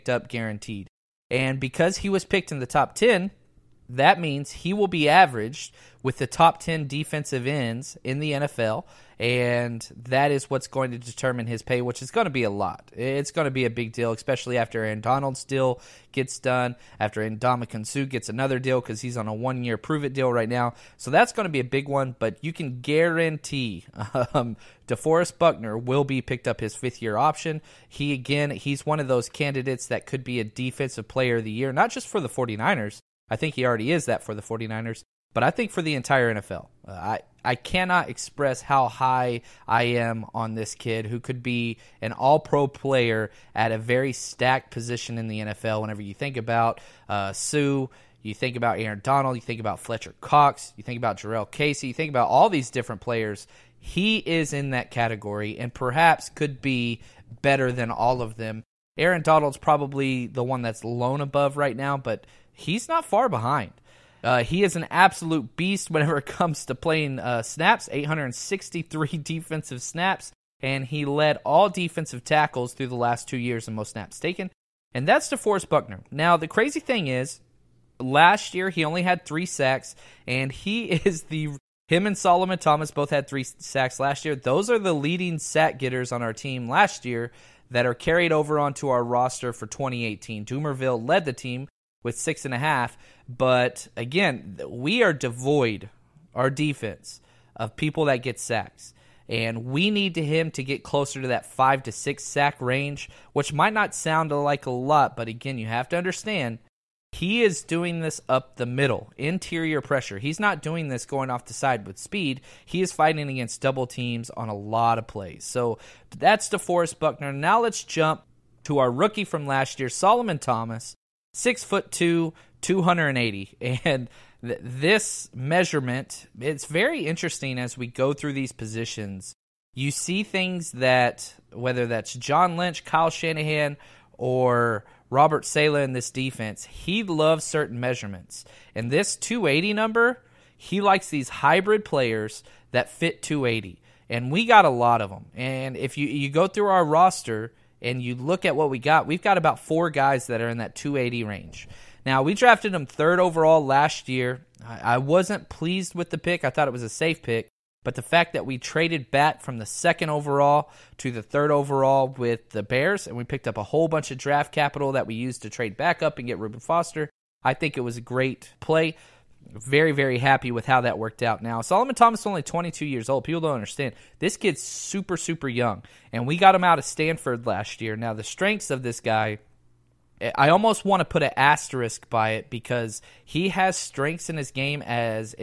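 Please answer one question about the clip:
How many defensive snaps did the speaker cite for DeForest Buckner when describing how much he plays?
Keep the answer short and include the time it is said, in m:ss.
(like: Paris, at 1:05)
863, at 1:07.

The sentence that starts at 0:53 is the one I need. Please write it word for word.
He is in that category and perhaps could be better than all of them.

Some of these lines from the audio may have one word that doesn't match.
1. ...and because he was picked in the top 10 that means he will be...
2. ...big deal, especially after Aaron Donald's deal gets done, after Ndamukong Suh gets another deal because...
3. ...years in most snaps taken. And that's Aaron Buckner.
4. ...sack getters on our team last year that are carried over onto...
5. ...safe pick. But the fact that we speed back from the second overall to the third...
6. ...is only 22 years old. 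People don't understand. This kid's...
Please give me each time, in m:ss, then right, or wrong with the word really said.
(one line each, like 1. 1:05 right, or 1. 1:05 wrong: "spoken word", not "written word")
1. 0:01 right
2. 0:13 right
3. 1:13 wrong: "DeForest", not "Aaron"
4. 1:25 right
5. 2:36 wrong: "traded", not "speed"
6. 2:52 right.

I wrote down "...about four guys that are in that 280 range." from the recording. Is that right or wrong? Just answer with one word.
right.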